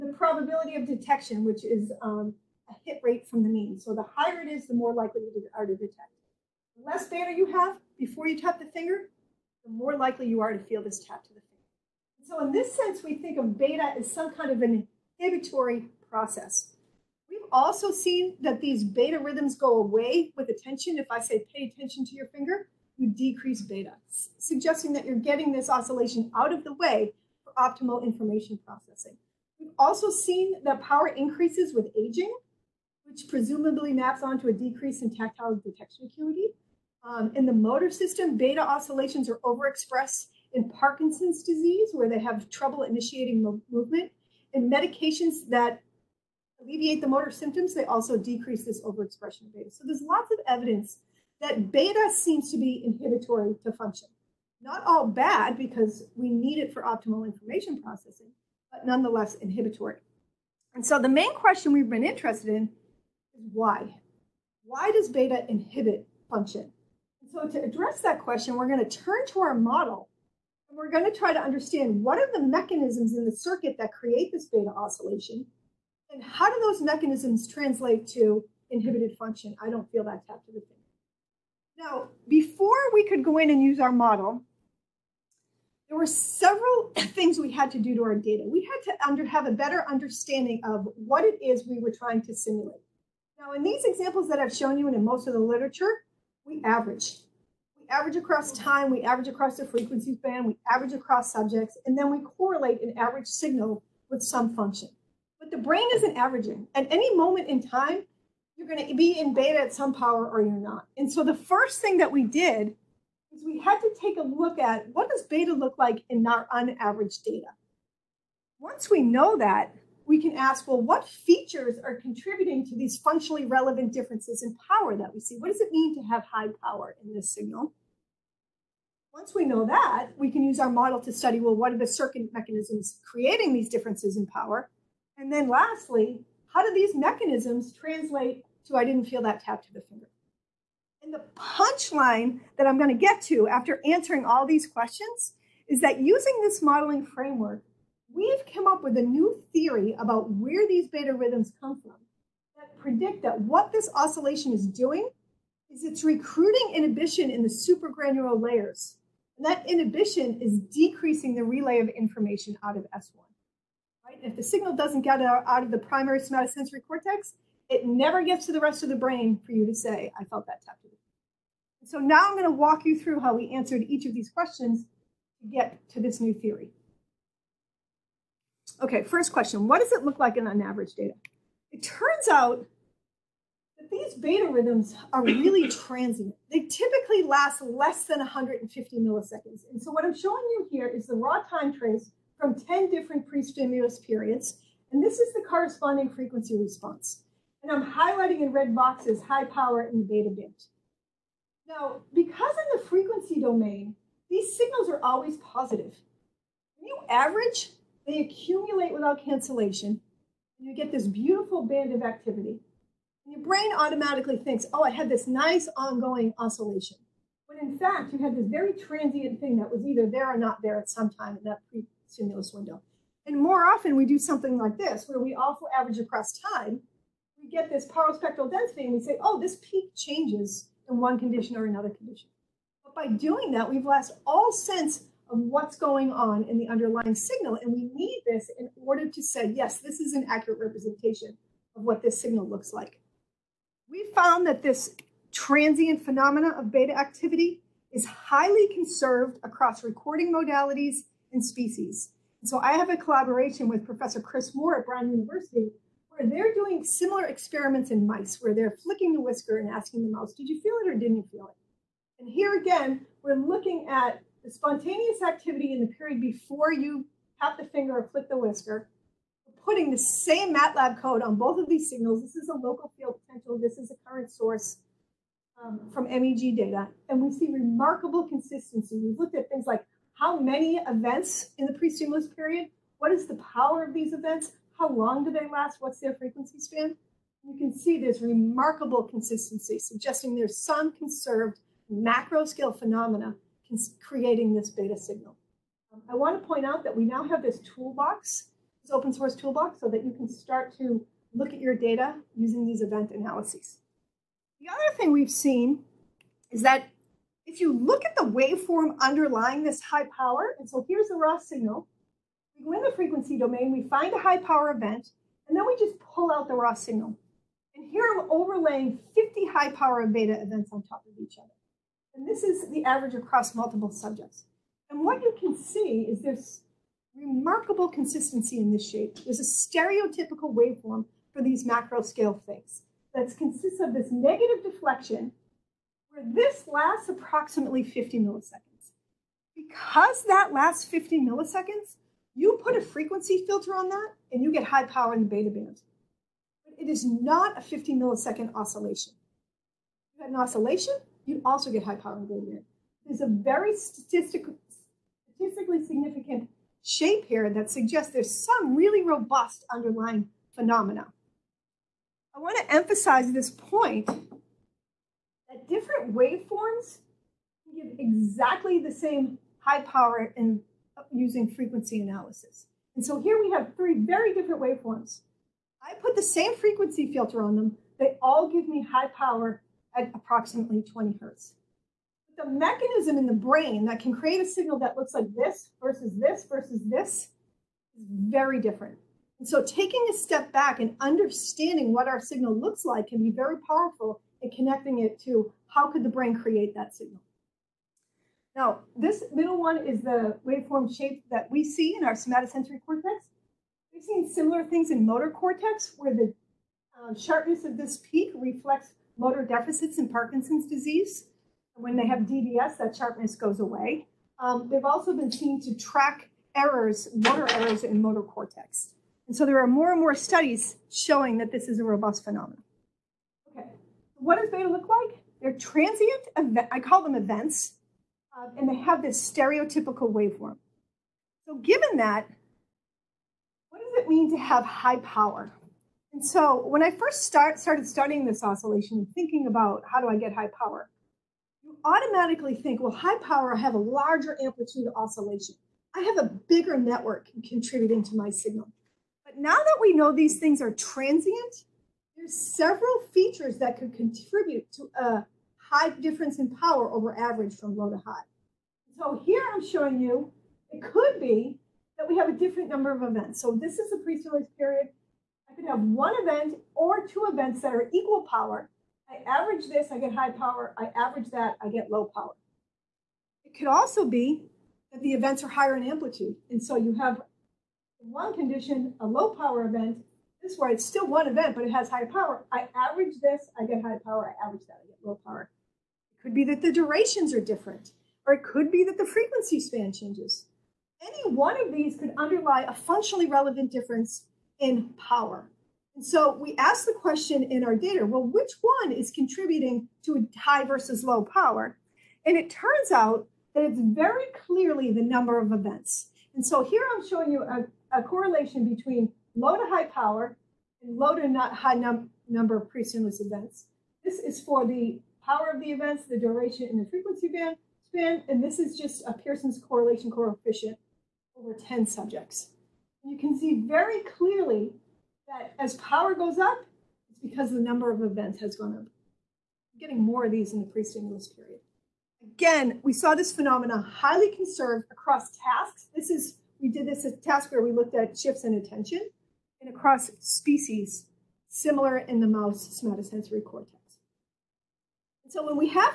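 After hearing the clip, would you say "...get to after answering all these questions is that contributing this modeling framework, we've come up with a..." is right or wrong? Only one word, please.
wrong.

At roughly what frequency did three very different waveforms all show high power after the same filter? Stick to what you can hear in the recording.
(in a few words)
20 hertz.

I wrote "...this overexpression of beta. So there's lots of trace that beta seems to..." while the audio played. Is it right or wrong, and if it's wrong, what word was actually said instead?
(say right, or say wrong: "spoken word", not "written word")
wrong: "evidence", not "trace".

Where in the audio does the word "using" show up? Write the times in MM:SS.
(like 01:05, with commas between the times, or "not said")
02:26, 05:02, 06:11.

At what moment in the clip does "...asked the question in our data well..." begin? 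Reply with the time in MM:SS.
08:16.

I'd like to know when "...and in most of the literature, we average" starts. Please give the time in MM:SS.
01:34.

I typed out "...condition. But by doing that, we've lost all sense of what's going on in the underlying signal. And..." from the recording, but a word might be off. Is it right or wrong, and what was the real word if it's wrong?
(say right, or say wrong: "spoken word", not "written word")
right.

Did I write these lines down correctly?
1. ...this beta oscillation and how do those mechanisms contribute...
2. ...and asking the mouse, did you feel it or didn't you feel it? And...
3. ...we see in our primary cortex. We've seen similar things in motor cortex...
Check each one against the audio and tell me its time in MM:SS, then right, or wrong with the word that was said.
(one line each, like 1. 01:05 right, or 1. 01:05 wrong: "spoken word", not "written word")
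1. 01:14 wrong: "translate", not "contribute"
2. 04:19 right
3. 06:41 wrong: "somatosensory", not "primary".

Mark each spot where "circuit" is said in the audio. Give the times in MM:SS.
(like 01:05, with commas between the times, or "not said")
01:13, 02:11.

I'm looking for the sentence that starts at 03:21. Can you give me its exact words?
Now, because in the frequency domain, these signals are always positive.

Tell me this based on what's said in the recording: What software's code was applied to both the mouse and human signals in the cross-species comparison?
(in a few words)
MATLAB.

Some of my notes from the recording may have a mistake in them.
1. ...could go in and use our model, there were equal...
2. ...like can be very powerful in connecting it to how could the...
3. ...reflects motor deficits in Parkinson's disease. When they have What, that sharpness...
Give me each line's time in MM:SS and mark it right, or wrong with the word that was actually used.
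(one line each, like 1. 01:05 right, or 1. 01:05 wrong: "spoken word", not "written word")
1. 01:23 wrong: "several", not "equal"
2. 06:32 right
3. 06:48 wrong: "DBS", not "What".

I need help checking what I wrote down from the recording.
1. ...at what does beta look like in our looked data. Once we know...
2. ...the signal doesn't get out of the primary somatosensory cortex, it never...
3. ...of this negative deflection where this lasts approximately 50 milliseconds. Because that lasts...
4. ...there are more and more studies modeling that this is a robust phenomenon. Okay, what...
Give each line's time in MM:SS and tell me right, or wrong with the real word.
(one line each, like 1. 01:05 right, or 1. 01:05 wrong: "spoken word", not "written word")
1. 01:54 wrong: "unaveraged", not "looked"
2. 02:44 right
3. 05:33 right
4. 06:59 wrong: "showing", not "modeling".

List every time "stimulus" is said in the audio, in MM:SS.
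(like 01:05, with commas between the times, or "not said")
03:13, 03:42, 04:41, 07:43, 08:32, 08:50.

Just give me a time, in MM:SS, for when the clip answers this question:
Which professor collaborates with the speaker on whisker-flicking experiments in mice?
04:14.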